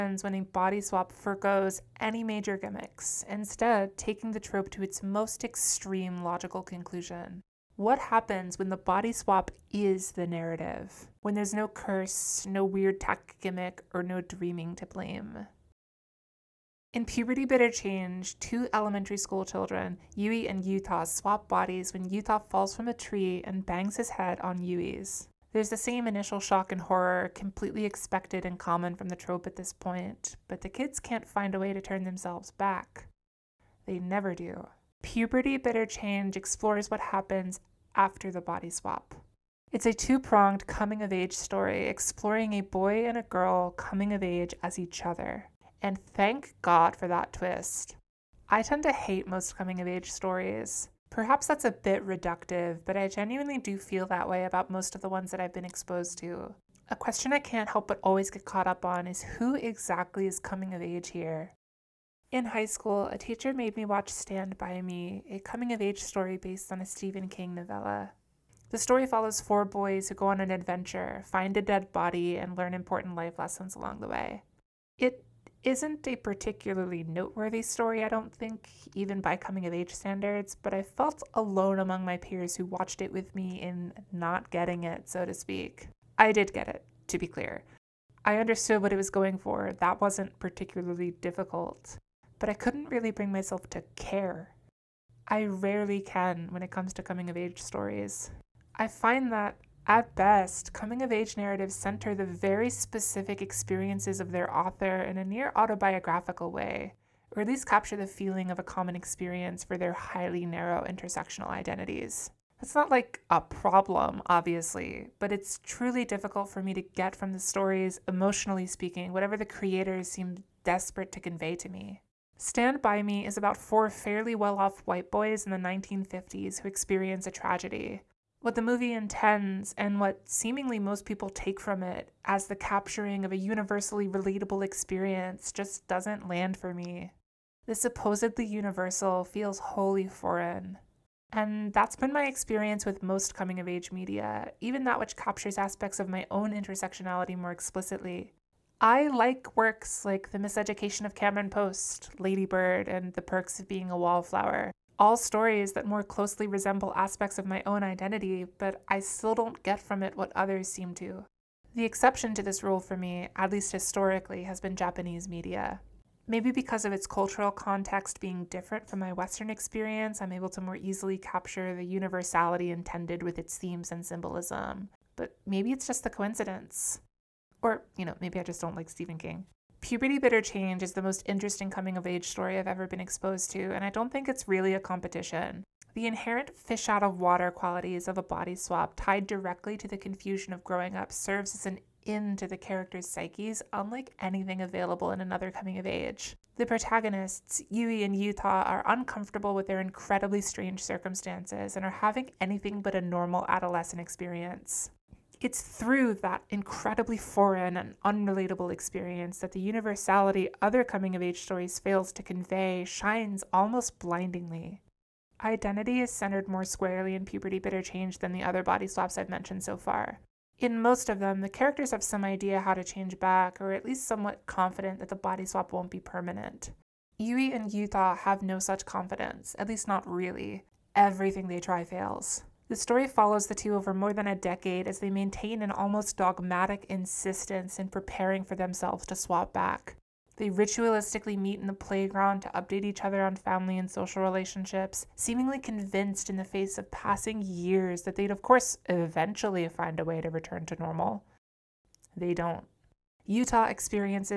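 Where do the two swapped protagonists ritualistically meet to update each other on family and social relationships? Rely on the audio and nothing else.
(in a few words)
The playground.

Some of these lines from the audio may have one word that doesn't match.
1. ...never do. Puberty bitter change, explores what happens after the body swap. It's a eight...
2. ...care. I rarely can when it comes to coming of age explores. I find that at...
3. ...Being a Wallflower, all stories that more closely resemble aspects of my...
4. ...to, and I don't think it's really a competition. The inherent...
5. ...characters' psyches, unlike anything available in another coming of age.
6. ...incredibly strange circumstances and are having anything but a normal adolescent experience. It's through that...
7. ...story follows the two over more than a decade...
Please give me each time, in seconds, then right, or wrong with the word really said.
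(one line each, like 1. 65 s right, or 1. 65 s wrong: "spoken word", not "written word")
1. 33 s wrong: "two", not "eight"
2. 93 s wrong: "stories", not "explores"
3. 153 s right
4. 183 s right
5. 192 s right
6. 199 s right
7. 232 s right.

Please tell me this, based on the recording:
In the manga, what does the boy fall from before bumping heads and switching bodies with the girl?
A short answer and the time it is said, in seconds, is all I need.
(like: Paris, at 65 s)
A tree, at 22 s.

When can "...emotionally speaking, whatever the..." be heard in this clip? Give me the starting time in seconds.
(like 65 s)
118 s.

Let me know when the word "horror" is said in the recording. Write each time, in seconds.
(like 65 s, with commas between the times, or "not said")
26 s.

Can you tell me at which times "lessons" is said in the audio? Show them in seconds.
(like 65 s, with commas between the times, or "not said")
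73 s.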